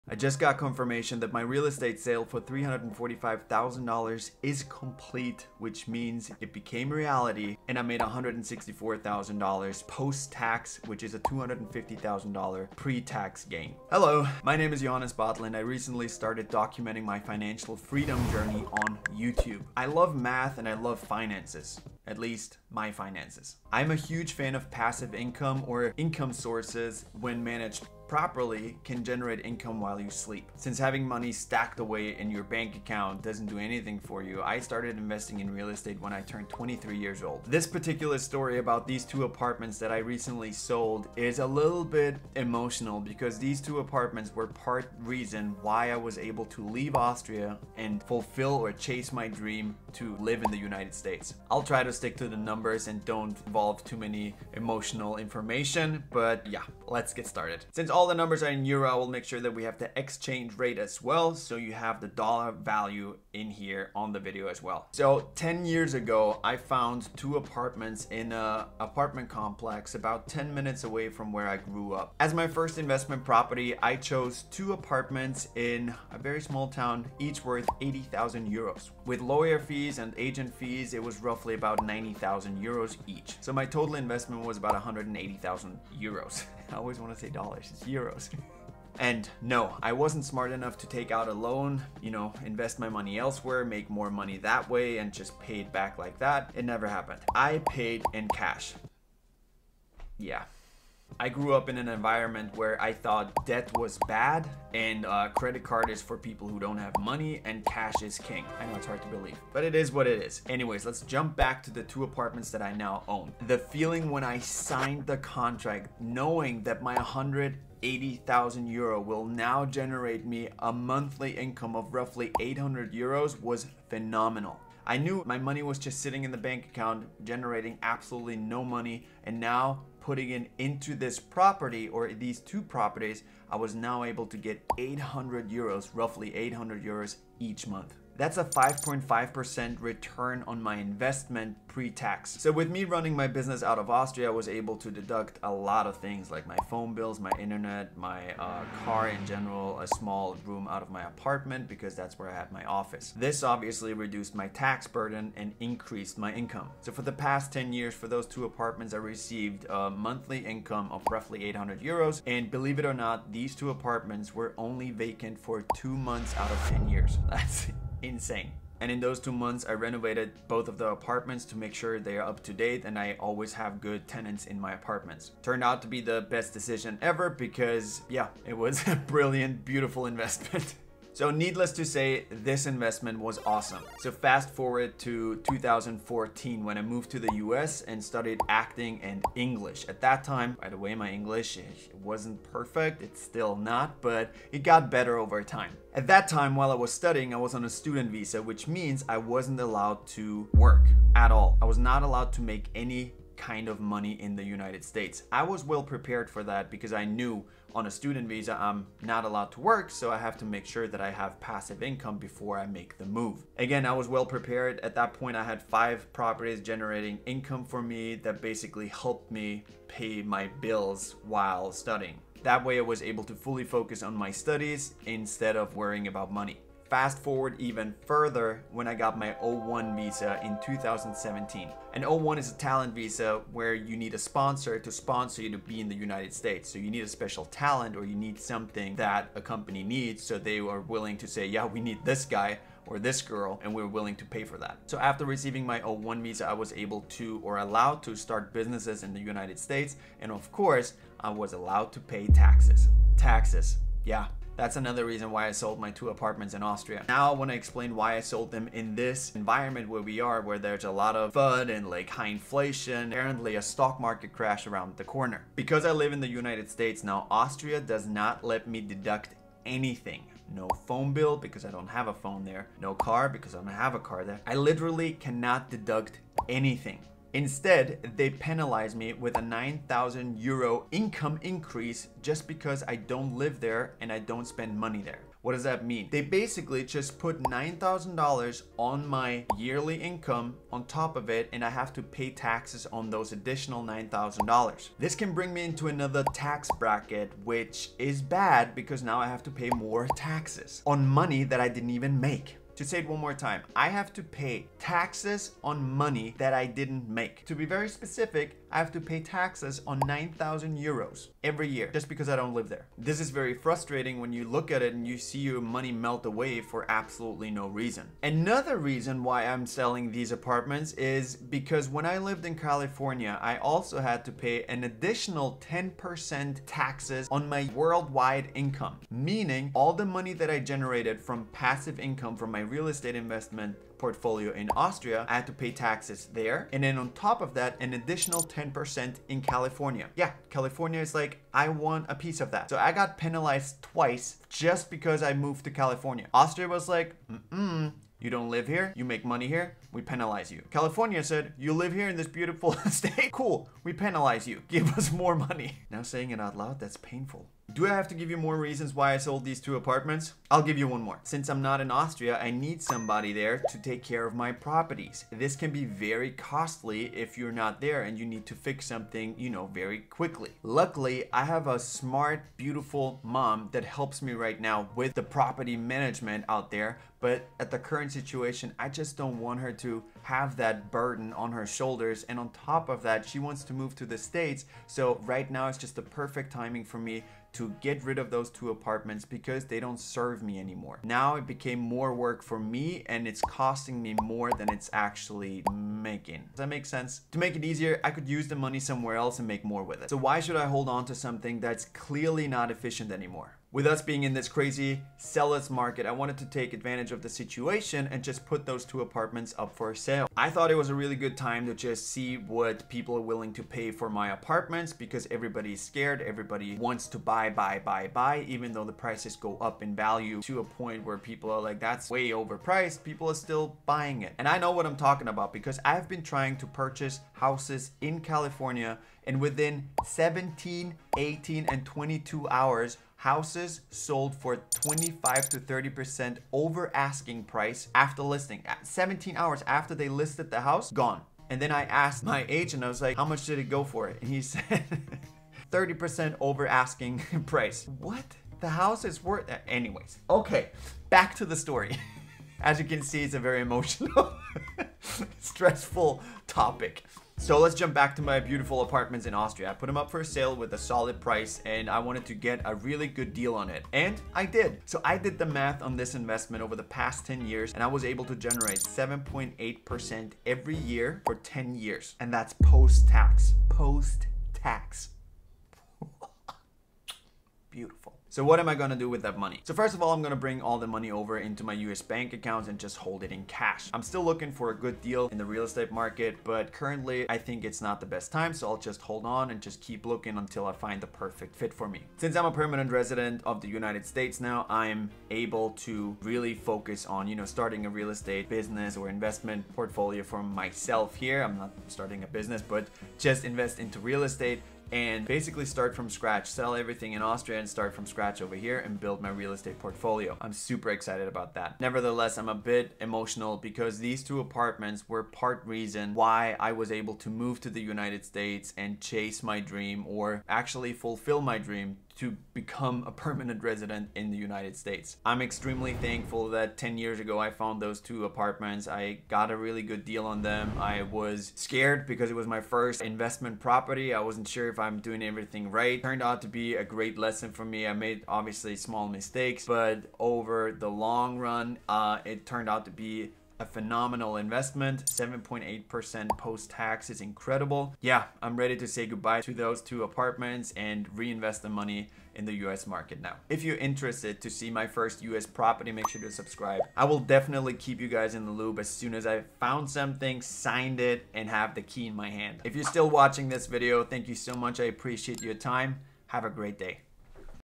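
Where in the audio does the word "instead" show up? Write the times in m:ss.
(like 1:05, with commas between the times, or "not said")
3:45, 4:37.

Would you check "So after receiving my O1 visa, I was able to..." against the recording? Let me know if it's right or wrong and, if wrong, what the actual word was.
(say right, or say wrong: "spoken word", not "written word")
right.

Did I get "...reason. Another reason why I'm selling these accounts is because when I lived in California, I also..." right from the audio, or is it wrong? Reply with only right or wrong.
wrong.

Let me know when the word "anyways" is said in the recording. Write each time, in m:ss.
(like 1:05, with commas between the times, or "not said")
1:50, 7:29.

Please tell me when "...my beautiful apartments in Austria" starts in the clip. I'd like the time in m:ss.
7:38.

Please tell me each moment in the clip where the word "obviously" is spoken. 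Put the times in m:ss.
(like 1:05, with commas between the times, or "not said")
2:33, 8:58.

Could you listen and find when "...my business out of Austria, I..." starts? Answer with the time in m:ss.
2:23.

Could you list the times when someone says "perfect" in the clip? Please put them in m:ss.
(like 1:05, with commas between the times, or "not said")
3:12, 6:26, 8:11.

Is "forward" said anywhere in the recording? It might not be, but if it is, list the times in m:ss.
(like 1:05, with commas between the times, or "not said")
3:04, 3:47.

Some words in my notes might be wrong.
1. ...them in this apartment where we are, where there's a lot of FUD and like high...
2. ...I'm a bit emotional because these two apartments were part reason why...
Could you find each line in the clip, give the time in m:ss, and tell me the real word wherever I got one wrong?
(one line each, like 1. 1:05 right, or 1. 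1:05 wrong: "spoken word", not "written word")
1. 4:18 wrong: "environment", not "apartment"
2. 8:32 right.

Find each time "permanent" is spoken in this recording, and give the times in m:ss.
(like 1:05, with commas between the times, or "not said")
8:12, 8:43.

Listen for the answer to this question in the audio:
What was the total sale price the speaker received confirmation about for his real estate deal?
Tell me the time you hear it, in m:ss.
0:02.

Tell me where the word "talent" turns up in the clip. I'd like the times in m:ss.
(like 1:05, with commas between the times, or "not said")
3:52, 3:57.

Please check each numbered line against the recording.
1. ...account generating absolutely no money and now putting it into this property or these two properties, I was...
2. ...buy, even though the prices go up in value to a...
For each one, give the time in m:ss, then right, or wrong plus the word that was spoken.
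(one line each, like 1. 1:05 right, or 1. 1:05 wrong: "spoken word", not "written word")
1. 2:06 right
2. 6:58 right.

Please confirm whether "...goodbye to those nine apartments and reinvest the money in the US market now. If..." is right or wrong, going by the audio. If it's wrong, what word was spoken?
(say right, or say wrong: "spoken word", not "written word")
wrong: "two", not "nine".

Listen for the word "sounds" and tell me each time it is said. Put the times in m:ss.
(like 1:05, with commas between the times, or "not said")
not said.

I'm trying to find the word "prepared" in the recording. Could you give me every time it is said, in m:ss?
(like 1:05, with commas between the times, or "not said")
3:25, 3:34.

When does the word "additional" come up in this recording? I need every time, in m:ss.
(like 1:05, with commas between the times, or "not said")
4:53, 5:24, 5:37.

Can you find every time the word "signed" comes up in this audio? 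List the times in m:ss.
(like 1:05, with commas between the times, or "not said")
1:54, 9:20.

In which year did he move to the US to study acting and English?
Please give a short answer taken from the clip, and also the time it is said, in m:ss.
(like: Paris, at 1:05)
2014, at 3:05.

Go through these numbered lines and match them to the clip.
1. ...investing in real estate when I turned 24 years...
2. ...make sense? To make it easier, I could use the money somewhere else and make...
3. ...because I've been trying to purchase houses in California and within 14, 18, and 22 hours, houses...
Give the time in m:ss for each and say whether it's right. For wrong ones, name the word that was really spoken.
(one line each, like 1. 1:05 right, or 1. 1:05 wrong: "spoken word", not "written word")
1. 0:34 wrong: "23", not "24"
2. 6:36 right
3. 7:05 wrong: "17", not "14".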